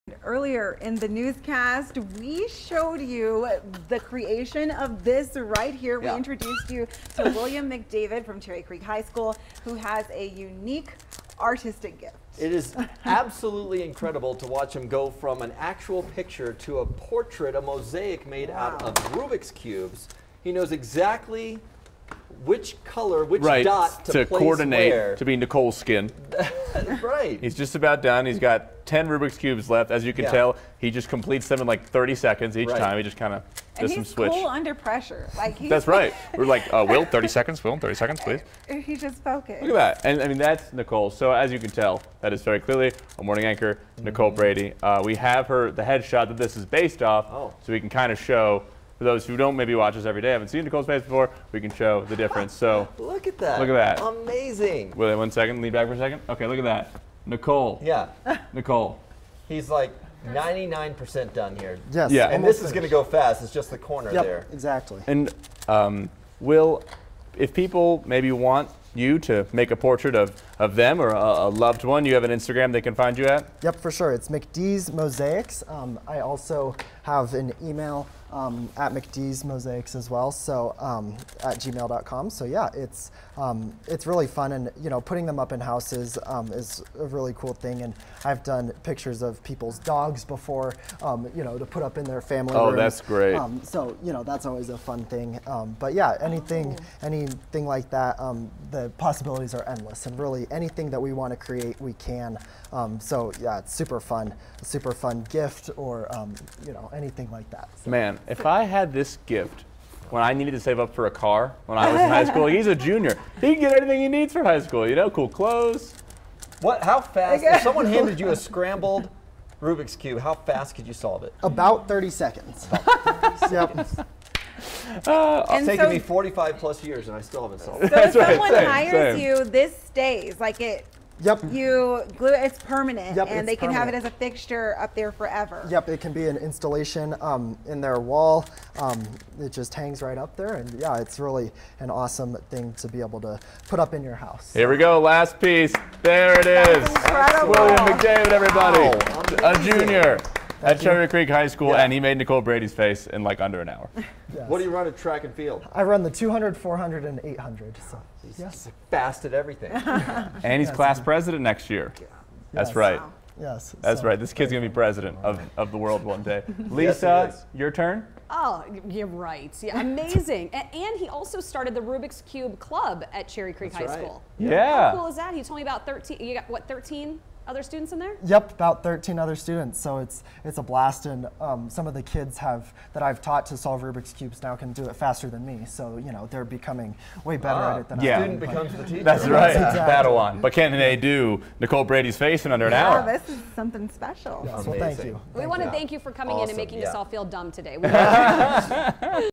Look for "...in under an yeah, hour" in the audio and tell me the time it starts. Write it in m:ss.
3:12.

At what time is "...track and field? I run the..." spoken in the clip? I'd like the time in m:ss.
2:34.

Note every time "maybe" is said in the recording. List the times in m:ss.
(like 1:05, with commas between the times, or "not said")
0:49, 1:08.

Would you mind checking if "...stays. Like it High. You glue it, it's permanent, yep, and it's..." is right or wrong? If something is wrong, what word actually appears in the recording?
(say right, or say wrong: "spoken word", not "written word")
wrong: "Yep", not "High".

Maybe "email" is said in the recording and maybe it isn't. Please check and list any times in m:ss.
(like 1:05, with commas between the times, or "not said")
1:17.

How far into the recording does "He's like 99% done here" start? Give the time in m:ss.
0:59.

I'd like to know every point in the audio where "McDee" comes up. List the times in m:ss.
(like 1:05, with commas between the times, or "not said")
1:14, 1:18.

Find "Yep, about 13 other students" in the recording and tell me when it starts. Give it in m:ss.
2:58.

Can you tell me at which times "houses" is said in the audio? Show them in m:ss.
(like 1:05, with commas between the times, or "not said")
1:25, 2:24.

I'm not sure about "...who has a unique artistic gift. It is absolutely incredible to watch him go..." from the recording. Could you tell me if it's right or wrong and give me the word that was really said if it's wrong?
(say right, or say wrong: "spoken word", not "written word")
right.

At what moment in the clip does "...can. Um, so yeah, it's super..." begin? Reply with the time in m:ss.
1:41.